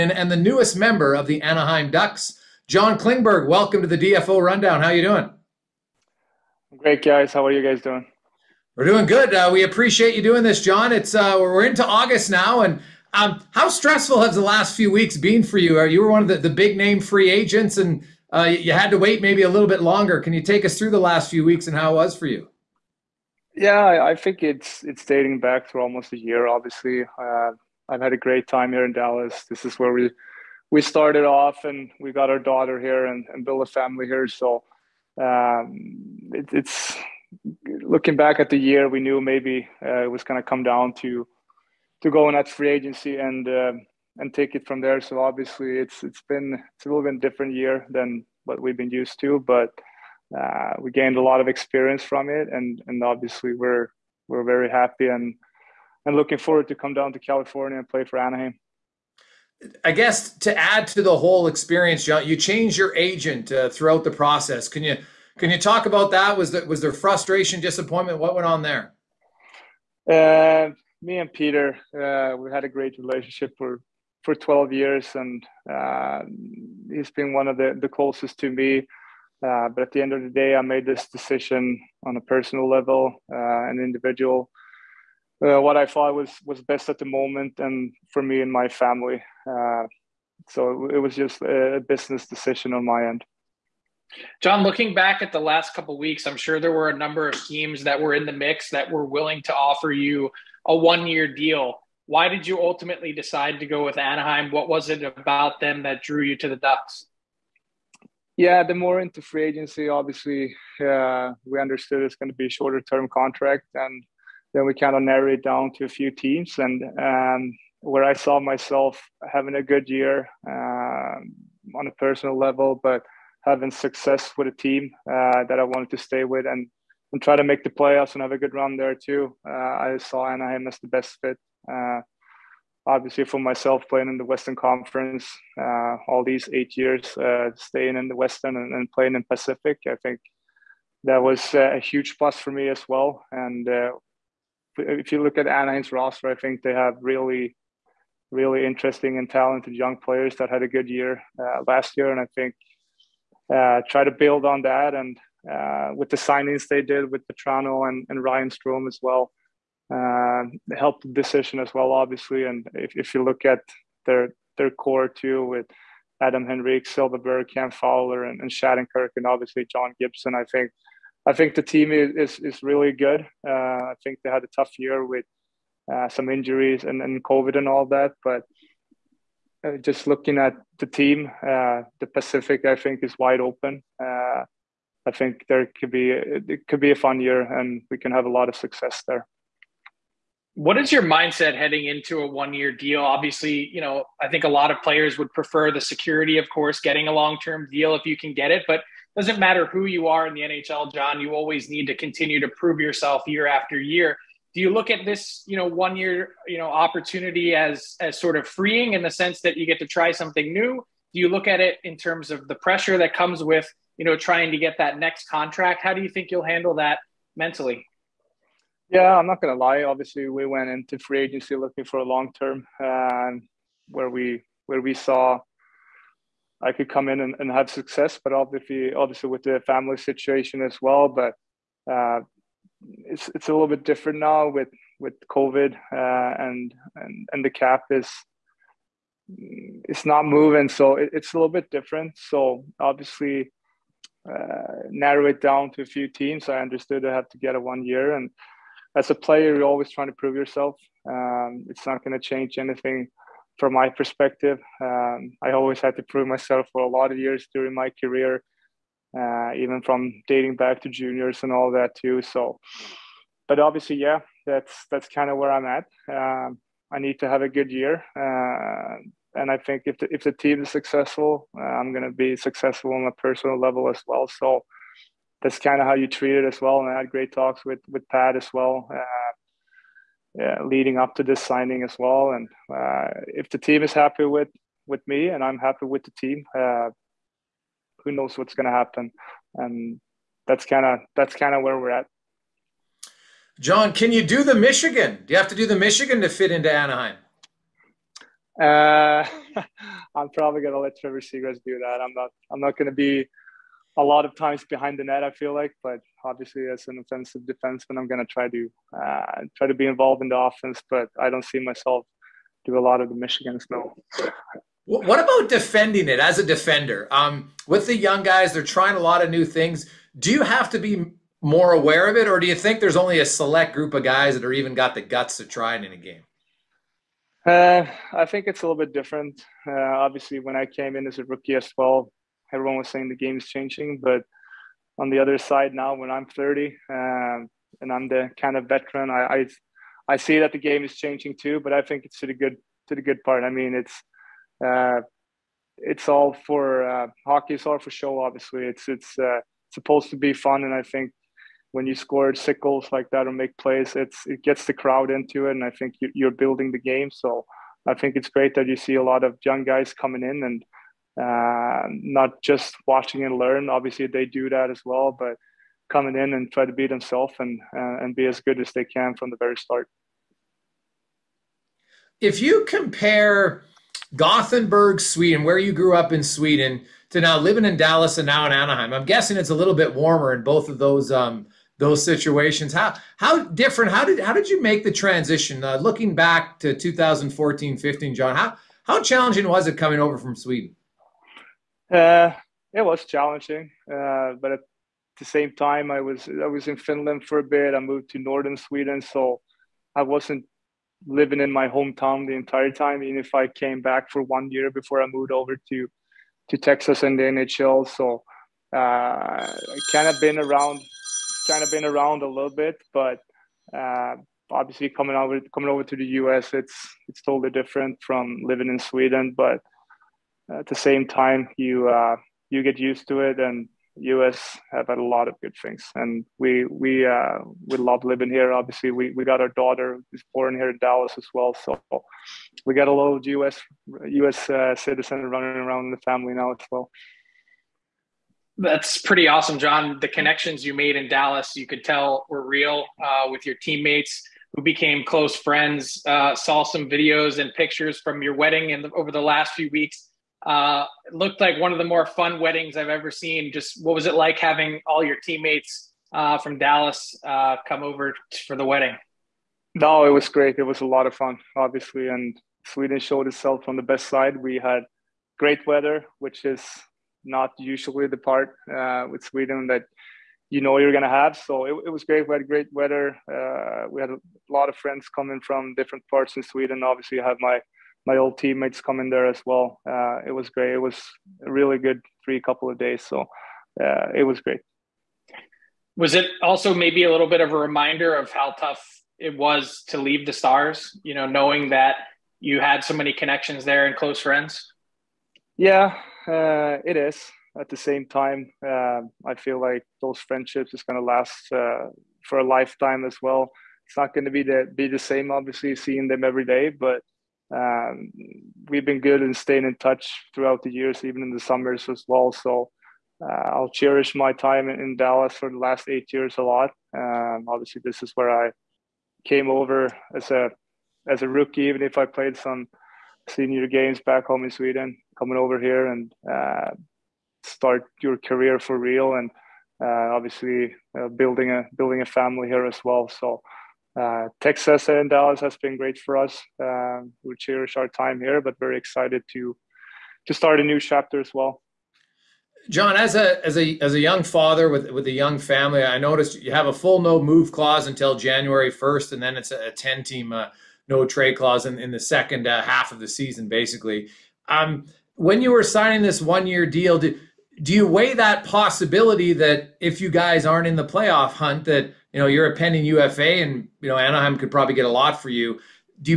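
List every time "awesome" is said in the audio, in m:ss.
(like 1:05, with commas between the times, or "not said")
7:19.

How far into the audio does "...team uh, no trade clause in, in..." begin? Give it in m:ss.
9:10.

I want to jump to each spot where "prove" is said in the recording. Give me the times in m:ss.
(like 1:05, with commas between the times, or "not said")
3:22, 4:10, 4:16.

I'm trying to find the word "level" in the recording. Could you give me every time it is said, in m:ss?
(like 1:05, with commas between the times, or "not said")
1:22, 2:02, 4:33.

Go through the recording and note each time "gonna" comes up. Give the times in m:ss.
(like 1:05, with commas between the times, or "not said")
4:31, 7:50.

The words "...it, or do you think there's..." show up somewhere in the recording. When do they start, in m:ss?
5:22.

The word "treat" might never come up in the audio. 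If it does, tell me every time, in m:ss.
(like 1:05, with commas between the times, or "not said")
4:36.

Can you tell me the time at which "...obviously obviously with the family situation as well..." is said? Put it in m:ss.
3:48.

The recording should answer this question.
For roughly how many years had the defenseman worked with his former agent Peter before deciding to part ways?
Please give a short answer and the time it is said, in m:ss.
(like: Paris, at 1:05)
12, at 1:14.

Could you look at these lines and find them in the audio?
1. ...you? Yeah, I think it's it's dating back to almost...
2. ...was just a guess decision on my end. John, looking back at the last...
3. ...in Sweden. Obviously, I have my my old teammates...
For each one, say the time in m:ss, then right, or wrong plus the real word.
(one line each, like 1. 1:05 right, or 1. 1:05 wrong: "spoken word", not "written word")
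1. 0:22 right
2. 1:30 wrong: "business", not "guess"
3. 7:56 right.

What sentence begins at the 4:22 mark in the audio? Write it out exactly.
So, but obviously, yeah, that's that's kind of where I'm at.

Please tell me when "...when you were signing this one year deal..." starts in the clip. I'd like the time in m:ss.
9:15.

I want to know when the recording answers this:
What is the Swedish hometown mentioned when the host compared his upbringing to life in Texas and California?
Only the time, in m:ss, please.
6:14.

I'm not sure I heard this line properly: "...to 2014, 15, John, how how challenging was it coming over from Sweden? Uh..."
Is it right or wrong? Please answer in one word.
right.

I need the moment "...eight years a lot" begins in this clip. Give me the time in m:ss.
8:35.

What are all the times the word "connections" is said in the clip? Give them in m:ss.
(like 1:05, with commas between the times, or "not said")
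7:20, 8:13.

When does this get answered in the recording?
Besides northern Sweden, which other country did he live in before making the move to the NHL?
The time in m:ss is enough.
6:36.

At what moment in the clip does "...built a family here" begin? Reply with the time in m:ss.
0:33.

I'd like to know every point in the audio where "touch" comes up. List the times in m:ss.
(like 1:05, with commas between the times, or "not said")
8:29.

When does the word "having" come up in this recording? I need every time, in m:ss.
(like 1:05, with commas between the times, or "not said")
1:59, 2:03, 7:34.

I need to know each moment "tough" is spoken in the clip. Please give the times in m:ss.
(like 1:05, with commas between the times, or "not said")
2:54, 8:08.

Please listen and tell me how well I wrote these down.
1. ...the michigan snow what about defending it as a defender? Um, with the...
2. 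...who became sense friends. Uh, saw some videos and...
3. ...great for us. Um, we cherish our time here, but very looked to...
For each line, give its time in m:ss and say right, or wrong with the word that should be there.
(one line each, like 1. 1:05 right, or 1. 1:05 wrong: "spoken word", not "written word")
1. 5:13 right
2. 7:24 wrong: "close", not "sense"
3. 8:55 wrong: "excited", not "looked".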